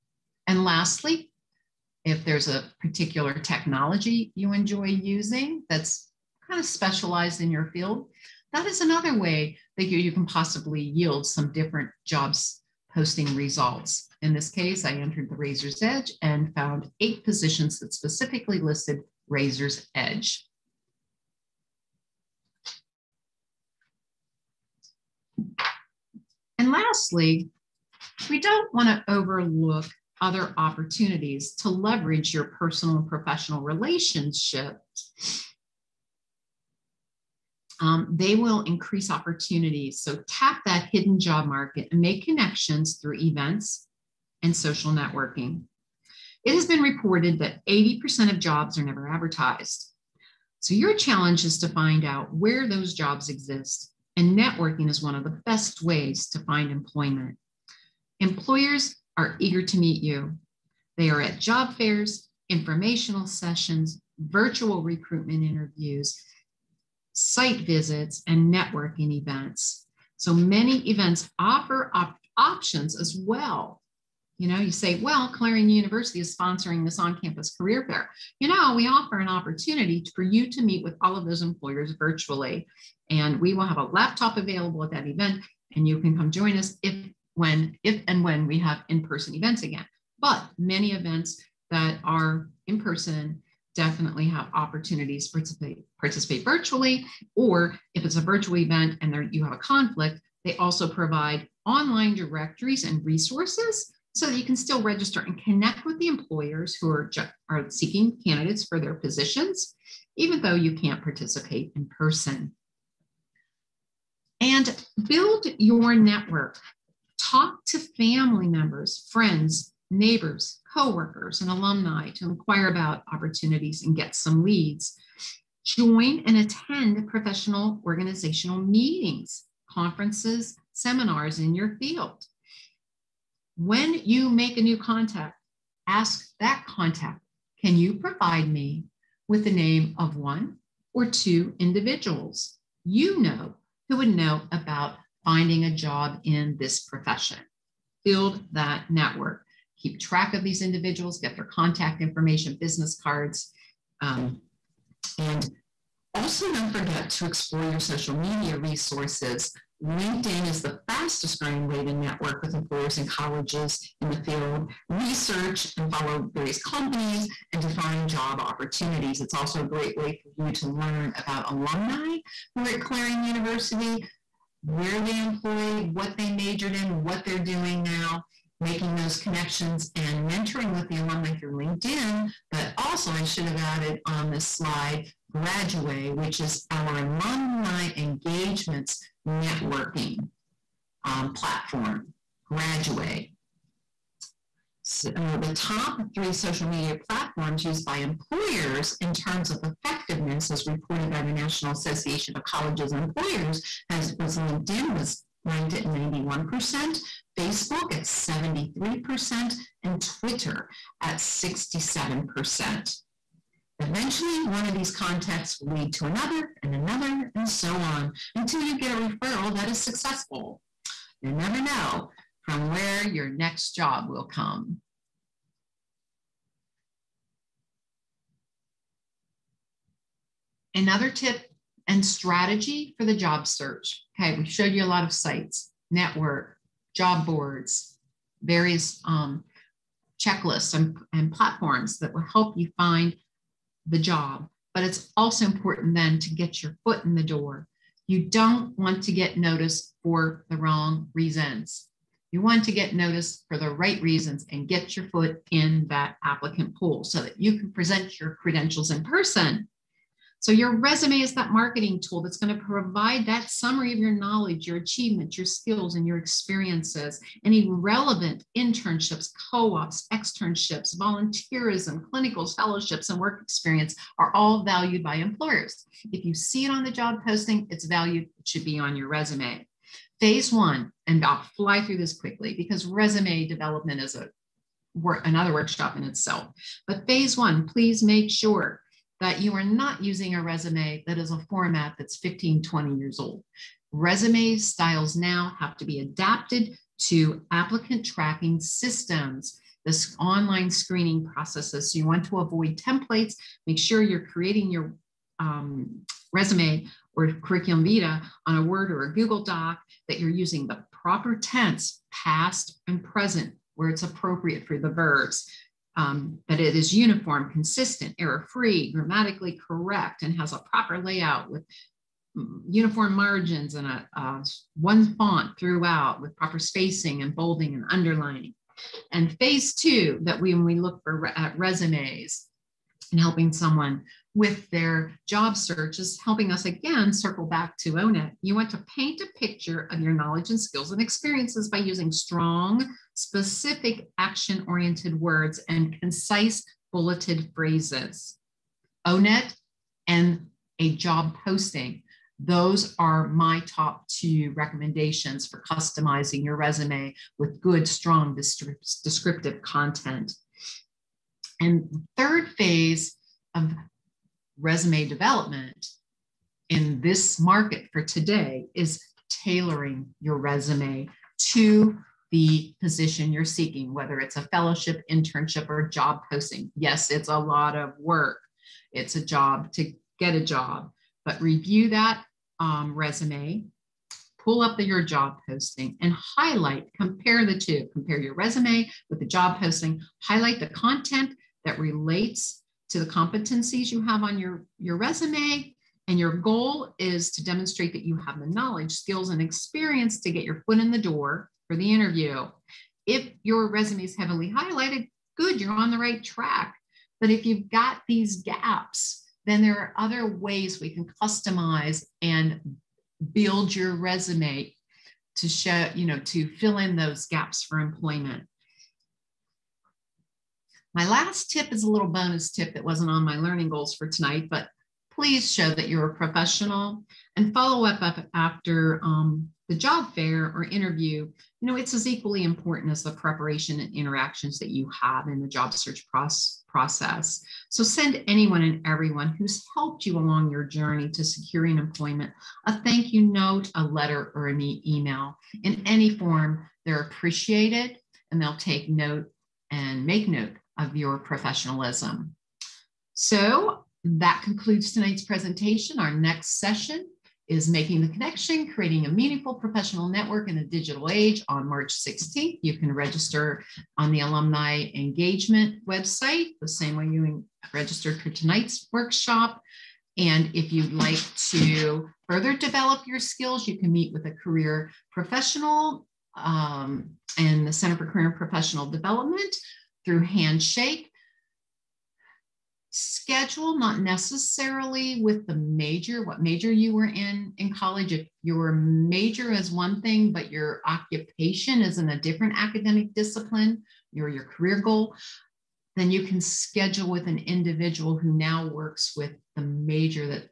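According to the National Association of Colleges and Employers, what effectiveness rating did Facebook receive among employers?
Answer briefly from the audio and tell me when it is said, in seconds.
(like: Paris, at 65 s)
73%, at 208 s.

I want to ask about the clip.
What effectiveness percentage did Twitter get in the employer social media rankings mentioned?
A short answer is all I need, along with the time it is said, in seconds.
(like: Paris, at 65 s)
67%, at 211 s.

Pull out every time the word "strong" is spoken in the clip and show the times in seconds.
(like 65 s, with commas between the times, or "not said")
342 s, 357 s.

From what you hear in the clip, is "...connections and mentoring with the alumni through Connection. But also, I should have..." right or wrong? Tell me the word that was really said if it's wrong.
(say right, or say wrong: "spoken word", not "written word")
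wrong: "LinkedIn", not "Connection".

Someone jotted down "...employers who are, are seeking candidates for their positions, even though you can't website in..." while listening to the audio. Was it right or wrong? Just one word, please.
wrong.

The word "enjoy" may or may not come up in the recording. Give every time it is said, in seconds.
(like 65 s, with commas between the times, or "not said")
4 s.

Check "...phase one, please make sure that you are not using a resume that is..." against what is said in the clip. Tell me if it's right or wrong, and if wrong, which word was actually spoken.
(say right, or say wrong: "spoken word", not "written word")
right.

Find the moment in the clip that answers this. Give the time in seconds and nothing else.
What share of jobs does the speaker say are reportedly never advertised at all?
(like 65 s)
47 s.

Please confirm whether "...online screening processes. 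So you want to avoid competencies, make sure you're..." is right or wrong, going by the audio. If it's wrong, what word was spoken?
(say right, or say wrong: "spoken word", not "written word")
wrong: "templates", not "competencies".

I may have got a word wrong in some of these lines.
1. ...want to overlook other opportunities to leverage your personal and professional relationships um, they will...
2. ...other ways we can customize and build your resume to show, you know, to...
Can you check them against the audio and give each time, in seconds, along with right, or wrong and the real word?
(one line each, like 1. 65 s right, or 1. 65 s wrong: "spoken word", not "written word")
1. 28 s right
2. 409 s right.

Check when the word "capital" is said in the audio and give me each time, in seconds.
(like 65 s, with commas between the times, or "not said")
not said.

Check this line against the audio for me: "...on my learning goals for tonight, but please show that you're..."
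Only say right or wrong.
right.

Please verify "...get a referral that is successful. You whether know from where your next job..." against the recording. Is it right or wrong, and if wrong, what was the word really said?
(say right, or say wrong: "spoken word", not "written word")
wrong: "never", not "whether".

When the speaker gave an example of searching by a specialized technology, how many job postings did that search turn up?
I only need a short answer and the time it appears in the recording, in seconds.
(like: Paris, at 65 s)
8, at 16 s.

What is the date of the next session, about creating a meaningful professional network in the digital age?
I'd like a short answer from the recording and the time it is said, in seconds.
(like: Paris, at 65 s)
March 16, at 461 s.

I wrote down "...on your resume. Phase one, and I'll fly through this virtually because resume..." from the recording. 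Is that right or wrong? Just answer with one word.
wrong.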